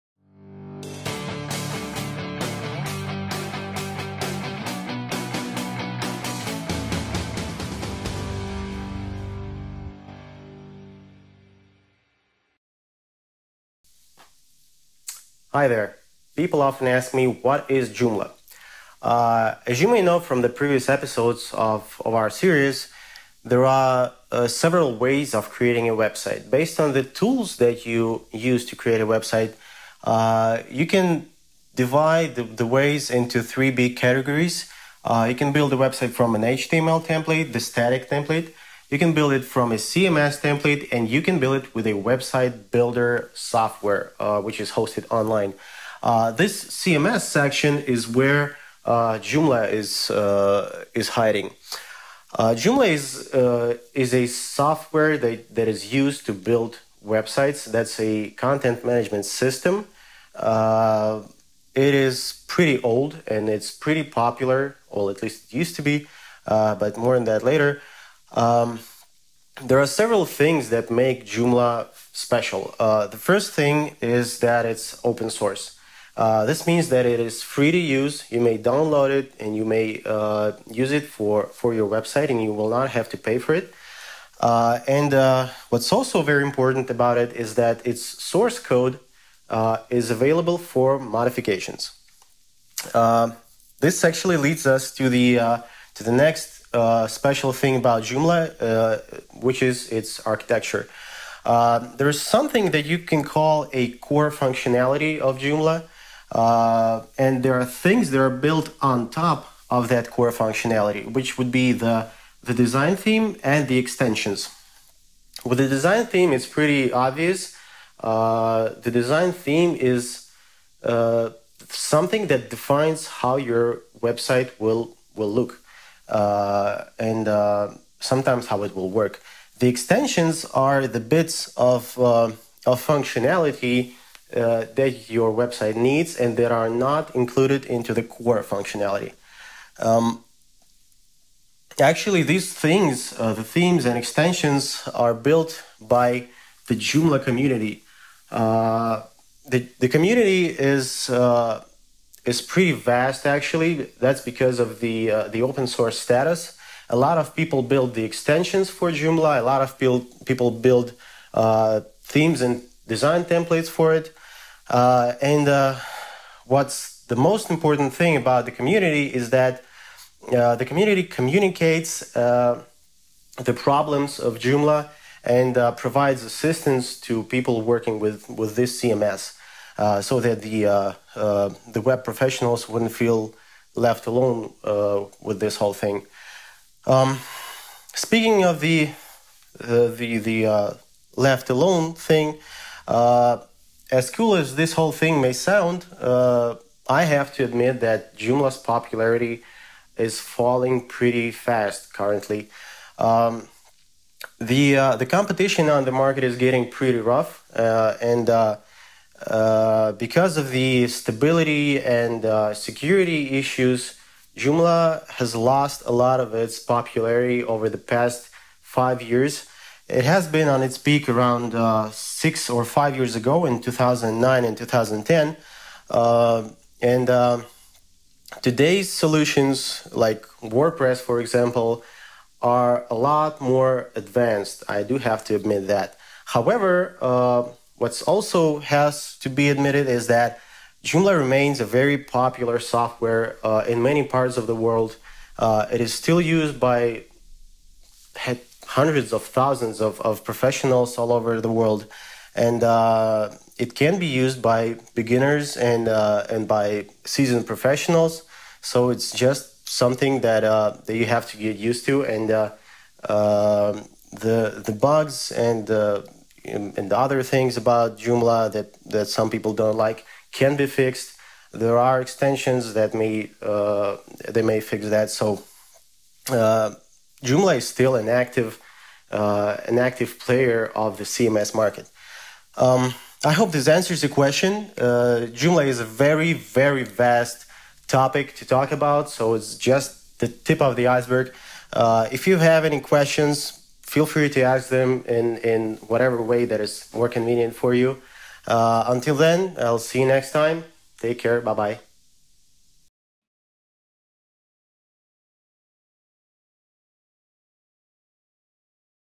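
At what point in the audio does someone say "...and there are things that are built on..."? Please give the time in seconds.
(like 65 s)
107 s.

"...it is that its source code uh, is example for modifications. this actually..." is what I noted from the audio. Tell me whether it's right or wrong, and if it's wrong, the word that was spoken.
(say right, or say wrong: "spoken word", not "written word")
wrong: "available", not "example".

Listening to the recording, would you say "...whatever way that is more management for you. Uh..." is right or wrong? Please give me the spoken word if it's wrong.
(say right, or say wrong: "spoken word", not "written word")
wrong: "convenient", not "management".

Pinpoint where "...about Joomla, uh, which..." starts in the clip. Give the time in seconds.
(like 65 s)
97 s.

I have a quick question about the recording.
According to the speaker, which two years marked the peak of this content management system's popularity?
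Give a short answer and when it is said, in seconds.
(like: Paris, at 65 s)
2009 and 2010, at 223 s.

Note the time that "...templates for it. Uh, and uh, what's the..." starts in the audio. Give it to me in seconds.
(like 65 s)
163 s.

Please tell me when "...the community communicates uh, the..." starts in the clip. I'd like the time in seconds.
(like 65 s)
170 s.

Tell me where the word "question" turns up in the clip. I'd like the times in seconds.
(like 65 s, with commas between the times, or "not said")
284 s, 292 s.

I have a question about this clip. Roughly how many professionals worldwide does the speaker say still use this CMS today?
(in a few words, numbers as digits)
hundreds of thousands.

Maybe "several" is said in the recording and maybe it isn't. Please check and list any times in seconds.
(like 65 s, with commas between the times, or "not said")
24 s, 69 s.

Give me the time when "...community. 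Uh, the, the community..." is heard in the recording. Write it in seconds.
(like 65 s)
147 s.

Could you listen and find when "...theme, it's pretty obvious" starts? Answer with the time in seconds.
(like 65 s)
116 s.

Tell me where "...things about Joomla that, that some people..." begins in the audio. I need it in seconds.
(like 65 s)
267 s.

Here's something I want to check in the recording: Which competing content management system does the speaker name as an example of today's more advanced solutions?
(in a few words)
WordPress.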